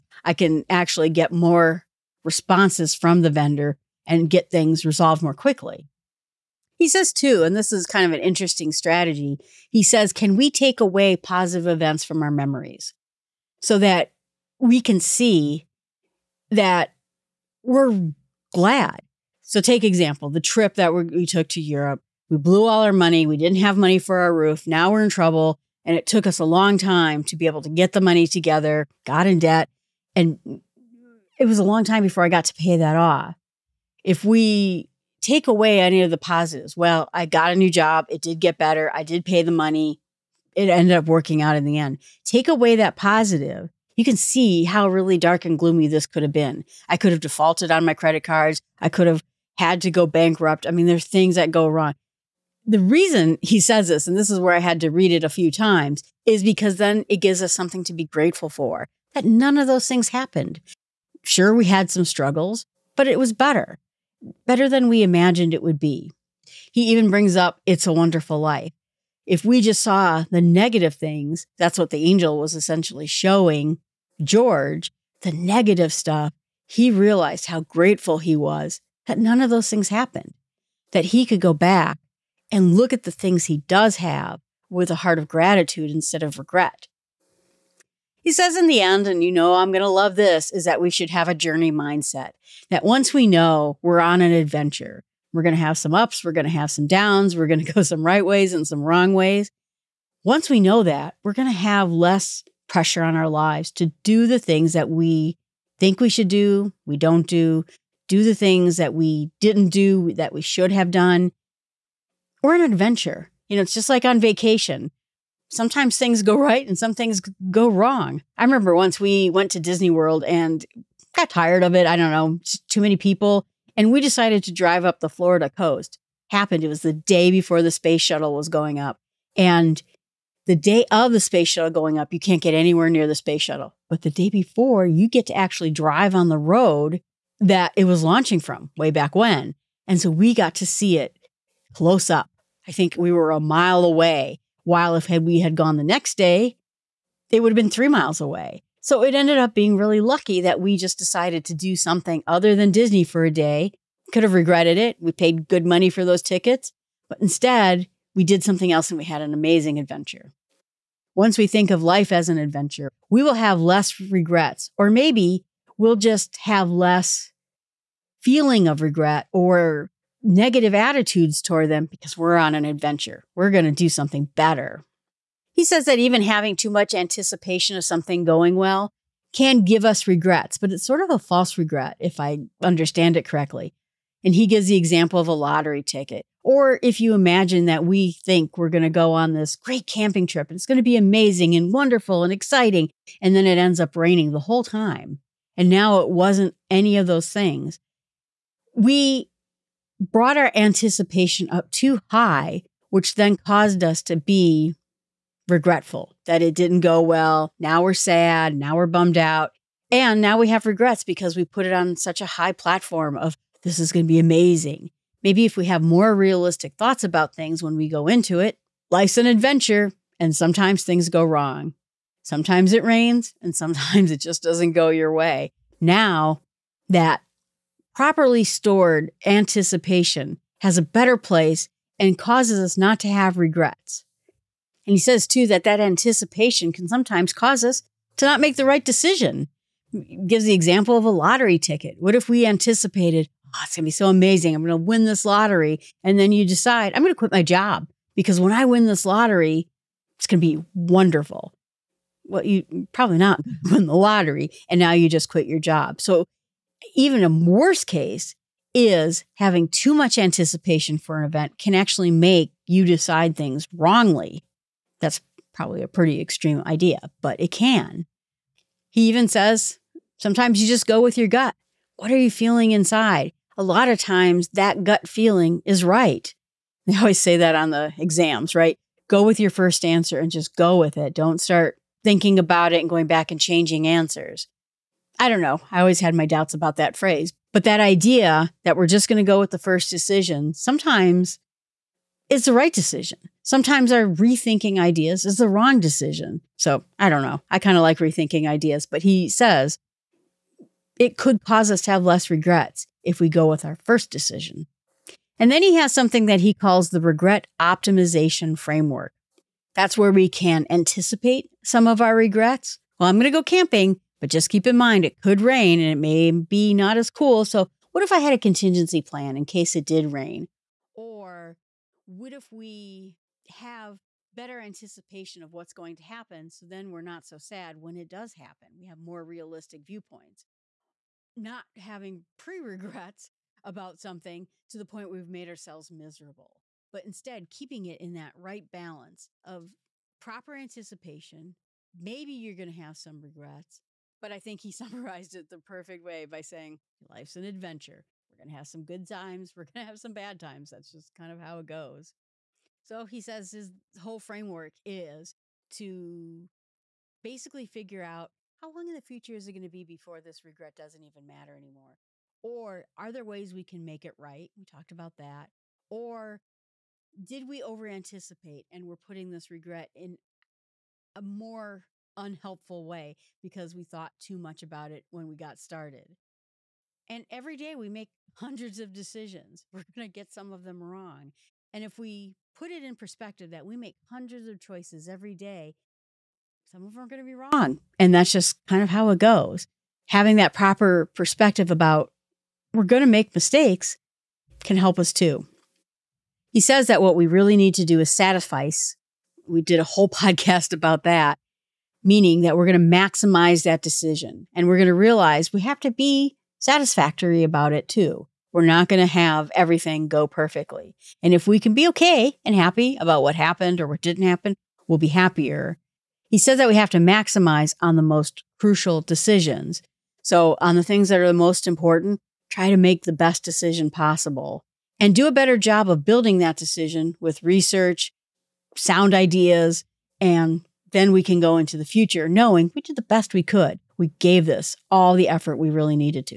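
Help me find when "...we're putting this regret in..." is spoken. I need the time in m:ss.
6:08.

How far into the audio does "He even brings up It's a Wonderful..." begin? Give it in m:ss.
1:06.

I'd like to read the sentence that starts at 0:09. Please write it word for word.
He says, can we take away positive events from our memories so that we can see that we're glad.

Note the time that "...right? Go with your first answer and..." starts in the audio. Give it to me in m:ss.
4:38.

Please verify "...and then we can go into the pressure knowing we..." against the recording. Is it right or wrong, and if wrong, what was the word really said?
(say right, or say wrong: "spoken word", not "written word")
wrong: "future", not "pressure".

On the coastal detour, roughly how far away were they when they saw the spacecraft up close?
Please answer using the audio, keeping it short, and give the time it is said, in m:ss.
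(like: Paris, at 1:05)
A mile, at 2:23.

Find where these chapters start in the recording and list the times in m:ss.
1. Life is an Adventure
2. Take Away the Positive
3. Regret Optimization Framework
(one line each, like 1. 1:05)
1. 1:27
2. 0:05
3. 5:04.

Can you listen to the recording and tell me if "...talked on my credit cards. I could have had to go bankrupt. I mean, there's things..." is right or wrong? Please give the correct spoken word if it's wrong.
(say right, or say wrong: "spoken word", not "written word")
wrong: "defaulted", not "talked".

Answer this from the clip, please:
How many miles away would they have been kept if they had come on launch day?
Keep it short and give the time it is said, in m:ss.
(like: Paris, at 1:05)
3 miles, at 2:27.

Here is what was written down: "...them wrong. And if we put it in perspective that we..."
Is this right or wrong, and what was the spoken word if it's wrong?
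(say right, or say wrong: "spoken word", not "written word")
right.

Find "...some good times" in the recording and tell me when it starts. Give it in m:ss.
5:48.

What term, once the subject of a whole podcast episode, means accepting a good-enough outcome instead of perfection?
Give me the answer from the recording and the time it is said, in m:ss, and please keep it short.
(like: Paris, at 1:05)
Satisfice, at 6:38.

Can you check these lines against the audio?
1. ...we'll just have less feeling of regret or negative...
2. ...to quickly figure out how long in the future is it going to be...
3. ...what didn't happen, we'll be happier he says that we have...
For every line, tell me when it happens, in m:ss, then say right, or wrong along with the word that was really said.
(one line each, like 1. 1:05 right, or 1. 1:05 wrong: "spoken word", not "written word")
1. 2:45 right
2. 5:55 wrong: "basically", not "quickly"
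3. 6:53 right.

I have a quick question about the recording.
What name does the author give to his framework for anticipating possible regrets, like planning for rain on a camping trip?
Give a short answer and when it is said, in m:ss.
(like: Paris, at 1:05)
Regret optimization framework, at 5:06.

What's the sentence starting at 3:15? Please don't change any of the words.
And now it wasn't any of those things.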